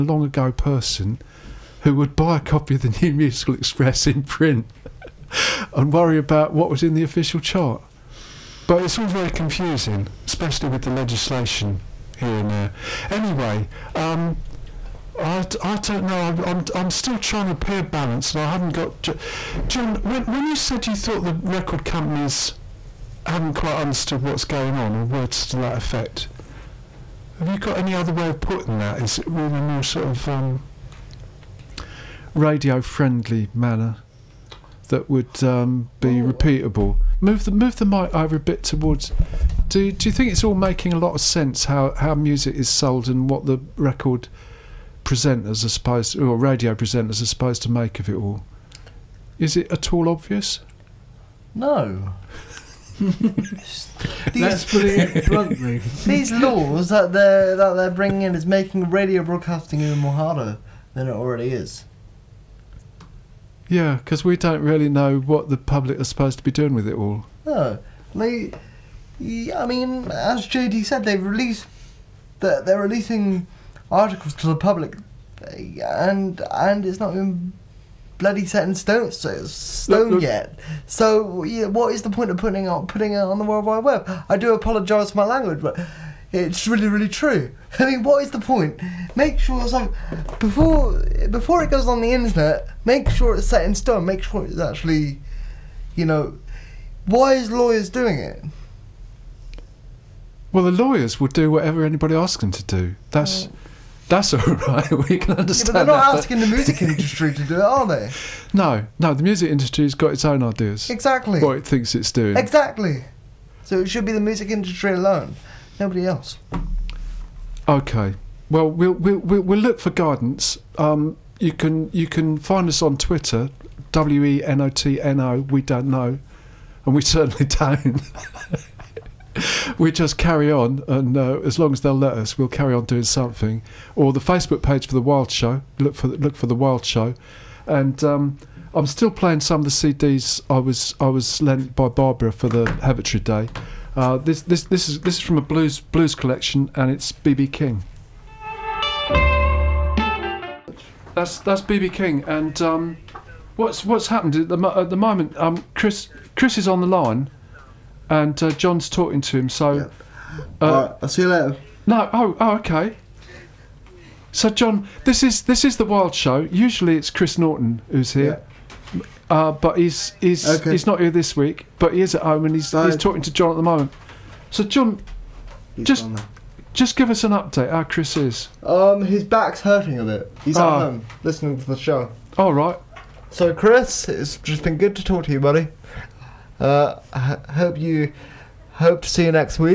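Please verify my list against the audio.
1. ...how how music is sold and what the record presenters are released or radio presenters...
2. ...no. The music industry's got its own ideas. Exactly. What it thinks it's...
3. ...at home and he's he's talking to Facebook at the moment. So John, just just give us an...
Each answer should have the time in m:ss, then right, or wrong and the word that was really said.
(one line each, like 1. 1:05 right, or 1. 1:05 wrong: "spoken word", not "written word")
1. 0:41 wrong: "supposed", not "released"
2. 1:48 right
3. 2:52 wrong: "John", not "Facebook".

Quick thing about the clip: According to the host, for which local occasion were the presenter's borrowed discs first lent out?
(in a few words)
Heavitree Day.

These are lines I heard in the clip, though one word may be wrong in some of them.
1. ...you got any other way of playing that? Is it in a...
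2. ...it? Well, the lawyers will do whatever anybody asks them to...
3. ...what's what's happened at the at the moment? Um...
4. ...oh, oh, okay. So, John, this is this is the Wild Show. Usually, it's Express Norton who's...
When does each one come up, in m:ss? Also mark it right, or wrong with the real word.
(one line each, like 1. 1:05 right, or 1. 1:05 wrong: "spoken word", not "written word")
1. 0:27 wrong: "putting", not "playing"
2. 1:38 right
3. 2:33 right
4. 2:42 wrong: "Chris", not "Express".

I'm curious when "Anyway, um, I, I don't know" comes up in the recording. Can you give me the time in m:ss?
0:13.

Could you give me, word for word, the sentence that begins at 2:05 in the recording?
We don't know, and we certainly don't.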